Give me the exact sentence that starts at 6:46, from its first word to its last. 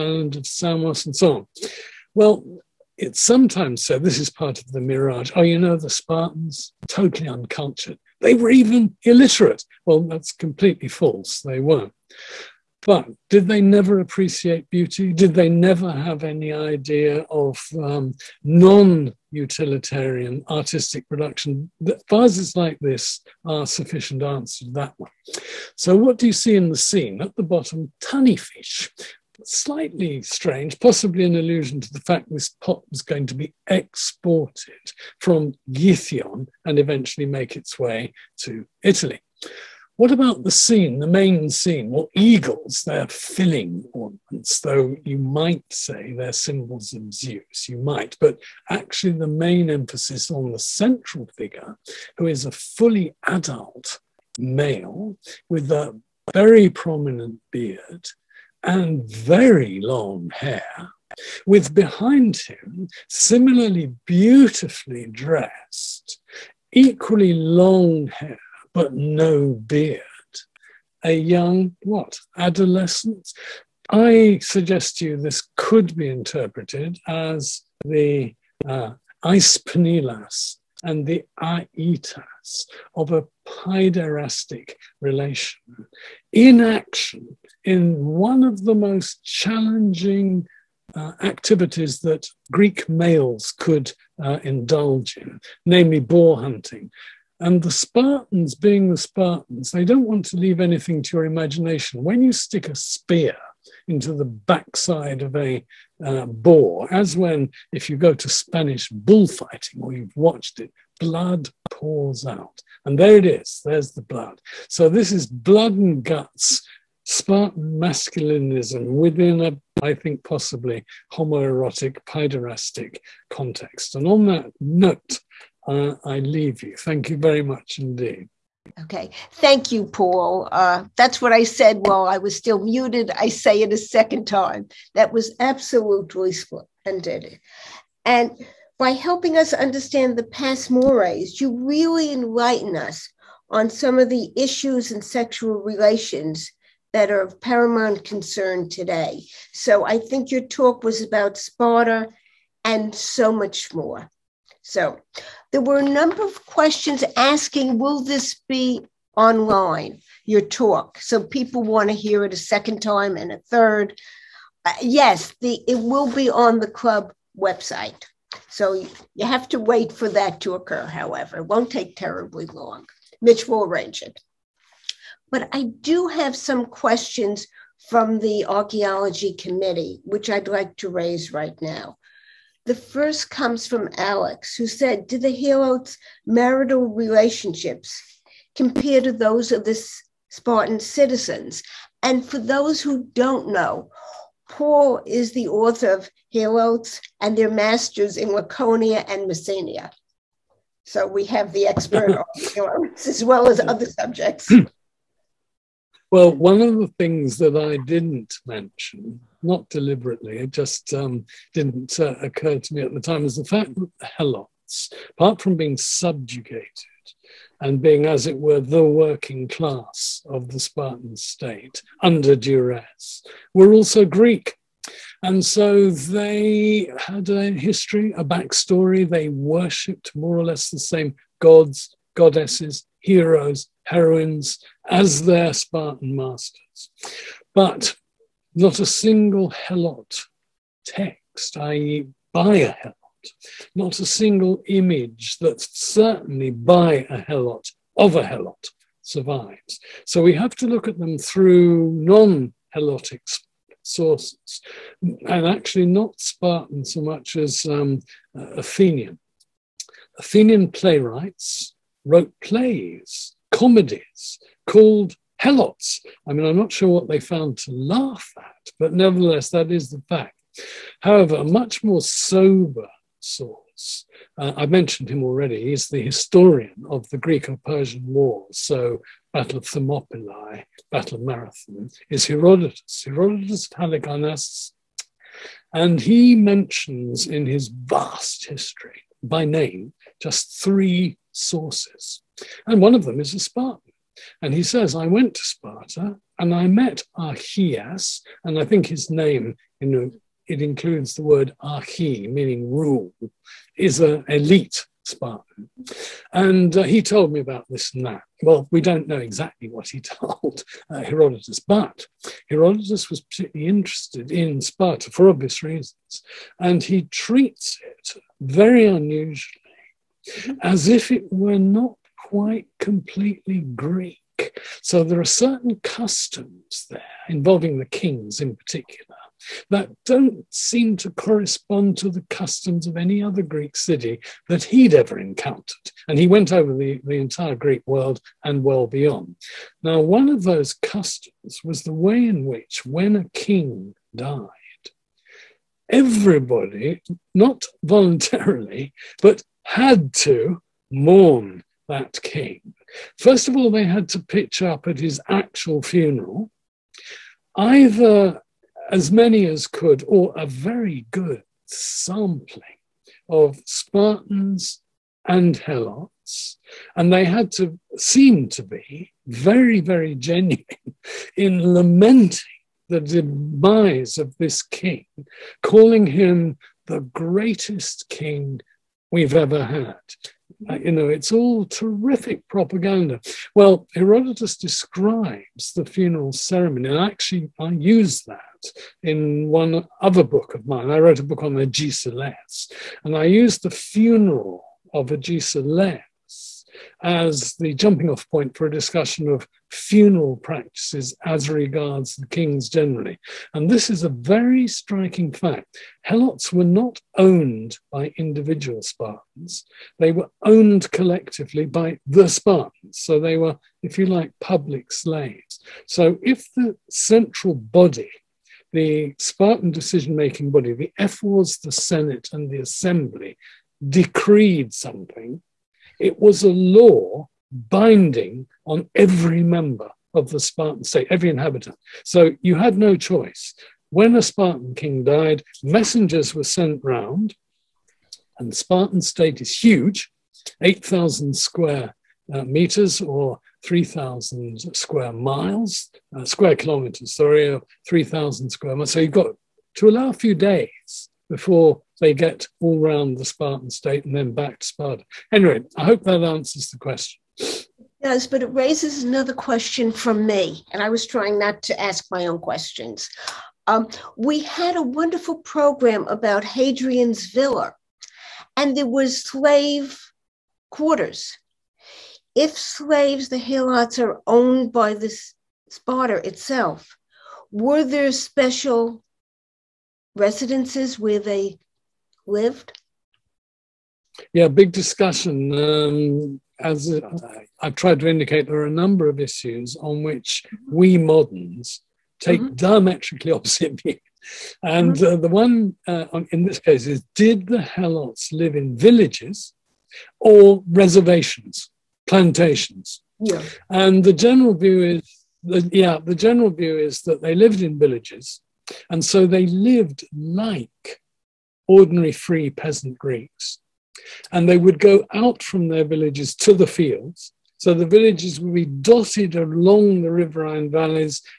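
Helots were not owned by individual Spartans, they were owned collectively by the Spartans.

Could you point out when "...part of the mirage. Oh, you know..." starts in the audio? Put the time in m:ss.
0:04.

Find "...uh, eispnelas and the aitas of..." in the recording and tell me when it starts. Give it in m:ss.
1:18.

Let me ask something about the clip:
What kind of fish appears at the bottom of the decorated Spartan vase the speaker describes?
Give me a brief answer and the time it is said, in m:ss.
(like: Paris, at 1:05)
Tunny fish, at 0:28.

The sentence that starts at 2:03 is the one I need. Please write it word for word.
And on that note, uh, I leave you.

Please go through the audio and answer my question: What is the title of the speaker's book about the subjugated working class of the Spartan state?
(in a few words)
Helots and their masters in Laconia and Messenia.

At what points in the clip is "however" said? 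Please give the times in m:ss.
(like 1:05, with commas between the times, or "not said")
2:50, 4:31.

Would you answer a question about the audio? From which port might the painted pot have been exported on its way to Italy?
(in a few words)
Githion.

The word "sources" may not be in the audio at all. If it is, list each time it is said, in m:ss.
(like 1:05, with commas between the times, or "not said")
4:13, 4:33, 4:51.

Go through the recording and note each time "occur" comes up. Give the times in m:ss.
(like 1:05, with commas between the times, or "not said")
2:50, 3:32.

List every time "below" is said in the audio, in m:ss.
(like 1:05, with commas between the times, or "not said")
not said.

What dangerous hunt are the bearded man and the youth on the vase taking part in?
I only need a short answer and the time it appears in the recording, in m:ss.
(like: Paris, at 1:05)
Boar hunting, at 1:36.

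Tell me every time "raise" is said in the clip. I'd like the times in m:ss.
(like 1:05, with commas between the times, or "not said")
3:00, 7:38.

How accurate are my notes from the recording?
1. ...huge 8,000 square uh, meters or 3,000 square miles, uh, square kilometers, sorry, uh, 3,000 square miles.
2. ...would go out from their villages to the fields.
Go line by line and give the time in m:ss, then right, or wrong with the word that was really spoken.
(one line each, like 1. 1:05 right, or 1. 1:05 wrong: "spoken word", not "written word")
1. 7:19 right
2. 8:34 right.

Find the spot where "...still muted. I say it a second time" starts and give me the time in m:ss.
2:12.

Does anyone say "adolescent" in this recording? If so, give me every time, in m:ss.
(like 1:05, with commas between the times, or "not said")
1:12.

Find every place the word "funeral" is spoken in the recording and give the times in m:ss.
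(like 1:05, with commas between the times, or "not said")
5:55, 6:25, 6:33, 6:39.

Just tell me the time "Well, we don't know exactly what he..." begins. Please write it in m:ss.
5:08.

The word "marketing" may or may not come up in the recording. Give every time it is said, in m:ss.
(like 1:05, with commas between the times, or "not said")
not said.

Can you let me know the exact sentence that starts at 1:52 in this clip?
And there it is, there's the blood.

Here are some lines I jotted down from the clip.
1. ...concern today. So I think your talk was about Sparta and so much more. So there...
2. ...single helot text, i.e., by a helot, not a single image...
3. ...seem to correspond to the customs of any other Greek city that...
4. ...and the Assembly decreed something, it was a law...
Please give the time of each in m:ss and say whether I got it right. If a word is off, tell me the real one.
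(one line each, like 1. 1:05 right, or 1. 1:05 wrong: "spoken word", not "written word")
1. 2:28 right
2. 3:58 right
3. 5:30 right
4. 7:02 right.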